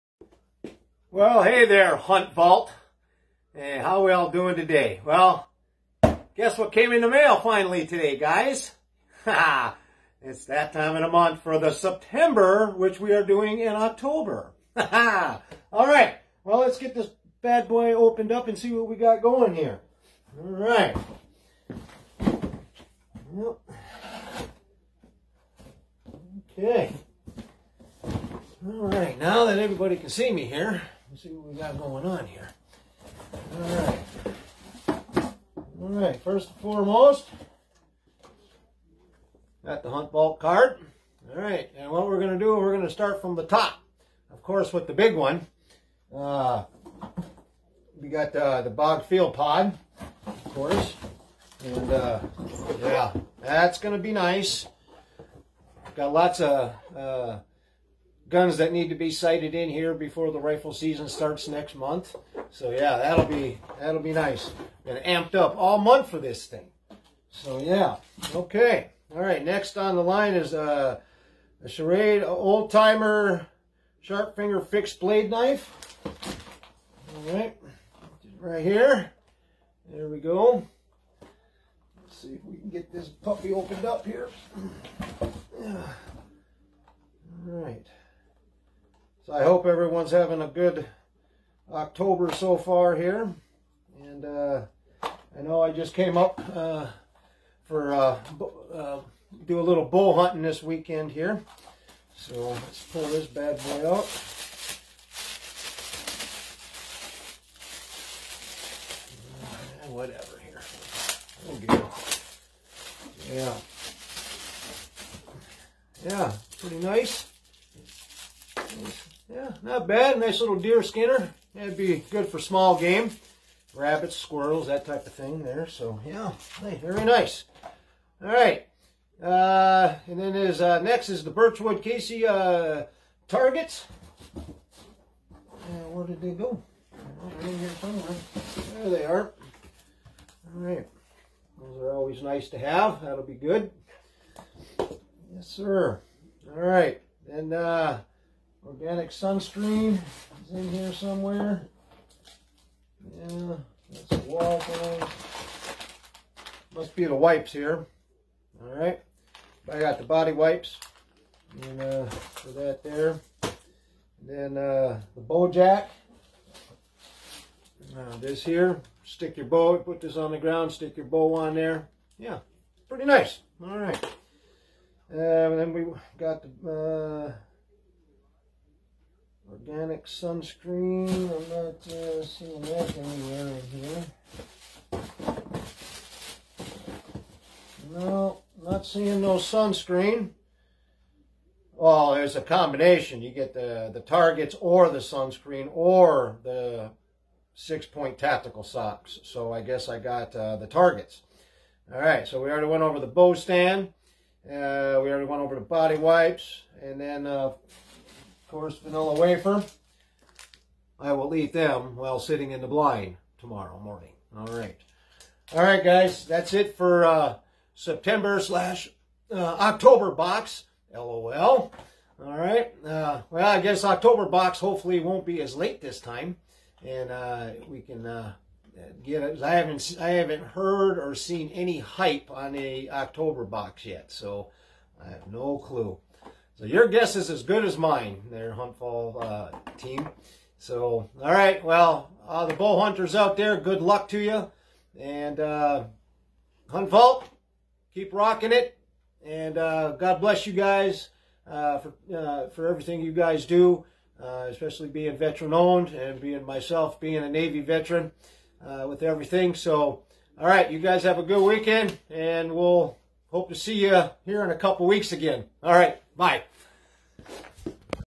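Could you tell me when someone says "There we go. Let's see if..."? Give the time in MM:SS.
01:19.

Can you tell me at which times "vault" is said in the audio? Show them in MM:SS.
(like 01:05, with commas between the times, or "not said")
00:02, 00:40.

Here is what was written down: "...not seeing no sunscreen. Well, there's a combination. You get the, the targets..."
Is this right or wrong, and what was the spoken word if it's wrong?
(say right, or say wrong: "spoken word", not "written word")
right.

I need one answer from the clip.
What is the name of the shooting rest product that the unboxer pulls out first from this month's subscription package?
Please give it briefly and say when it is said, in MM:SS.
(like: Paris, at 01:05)
Bog Field Pod, at 00:48.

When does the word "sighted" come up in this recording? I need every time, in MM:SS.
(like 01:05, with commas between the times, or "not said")
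00:59.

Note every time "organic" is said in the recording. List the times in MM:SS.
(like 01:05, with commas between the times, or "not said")
02:28, 02:59.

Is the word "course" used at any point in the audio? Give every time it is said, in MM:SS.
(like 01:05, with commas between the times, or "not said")
00:44, 00:50, 03:28.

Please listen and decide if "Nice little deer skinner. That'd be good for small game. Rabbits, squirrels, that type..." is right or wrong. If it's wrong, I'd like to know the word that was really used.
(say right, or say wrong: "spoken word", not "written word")
right.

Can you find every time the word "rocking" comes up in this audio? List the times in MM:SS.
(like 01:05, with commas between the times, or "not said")
04:08.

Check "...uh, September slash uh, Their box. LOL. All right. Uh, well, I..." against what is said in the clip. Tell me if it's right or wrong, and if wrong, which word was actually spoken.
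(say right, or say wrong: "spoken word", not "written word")
wrong: "October", not "Their".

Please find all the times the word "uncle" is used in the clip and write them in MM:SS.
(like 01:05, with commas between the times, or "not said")
not said.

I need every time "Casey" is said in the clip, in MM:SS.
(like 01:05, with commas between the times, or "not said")
02:11.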